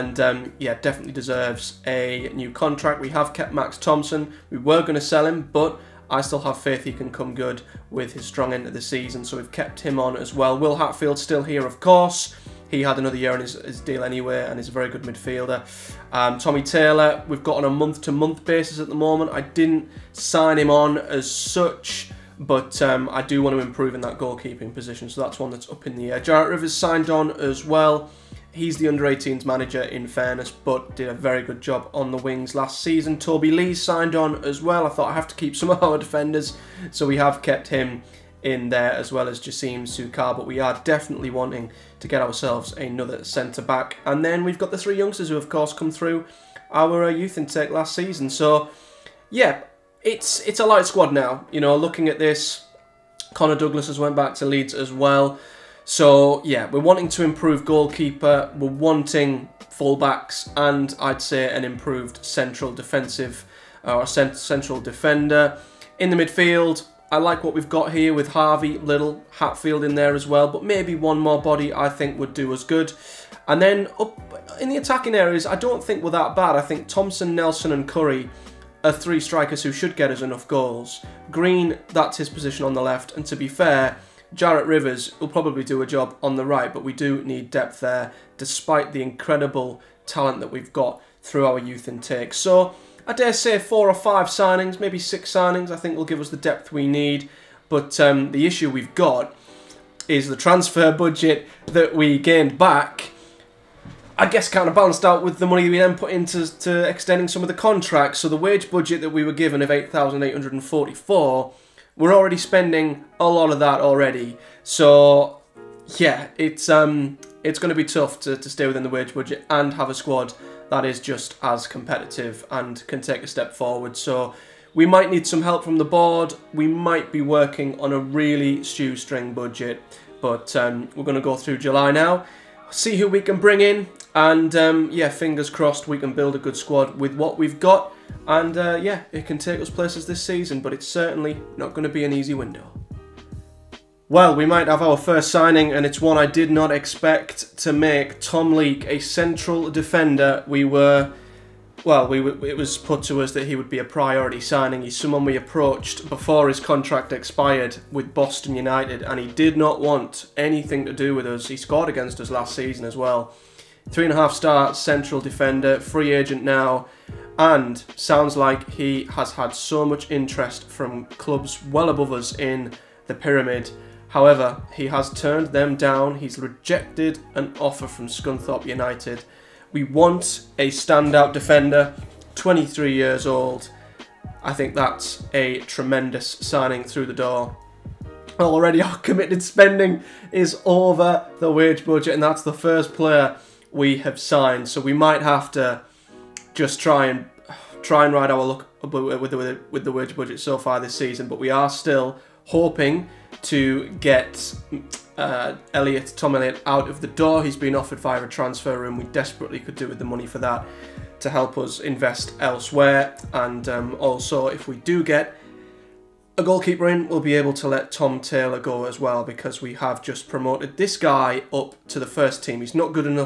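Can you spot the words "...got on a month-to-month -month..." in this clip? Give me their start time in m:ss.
0:17.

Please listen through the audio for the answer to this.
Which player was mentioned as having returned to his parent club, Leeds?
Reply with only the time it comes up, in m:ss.
0:53.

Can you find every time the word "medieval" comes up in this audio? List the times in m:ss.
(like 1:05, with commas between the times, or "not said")
not said.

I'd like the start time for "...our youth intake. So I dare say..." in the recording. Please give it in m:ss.
1:31.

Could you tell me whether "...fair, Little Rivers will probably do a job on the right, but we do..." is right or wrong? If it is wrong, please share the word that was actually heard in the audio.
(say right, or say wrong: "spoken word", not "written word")
wrong: "Jarrett", not "Little".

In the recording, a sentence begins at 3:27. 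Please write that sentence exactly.
He's been offered via a transfer room.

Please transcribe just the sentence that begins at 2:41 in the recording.
He scored against us last season as well.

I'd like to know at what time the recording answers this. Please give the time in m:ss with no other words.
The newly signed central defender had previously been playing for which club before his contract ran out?
2:38.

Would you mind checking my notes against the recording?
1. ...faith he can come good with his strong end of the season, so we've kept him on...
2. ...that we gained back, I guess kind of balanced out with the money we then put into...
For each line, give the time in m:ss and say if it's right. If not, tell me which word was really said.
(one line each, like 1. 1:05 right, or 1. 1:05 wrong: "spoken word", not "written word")
1. 0:06 right
2. 1:41 right.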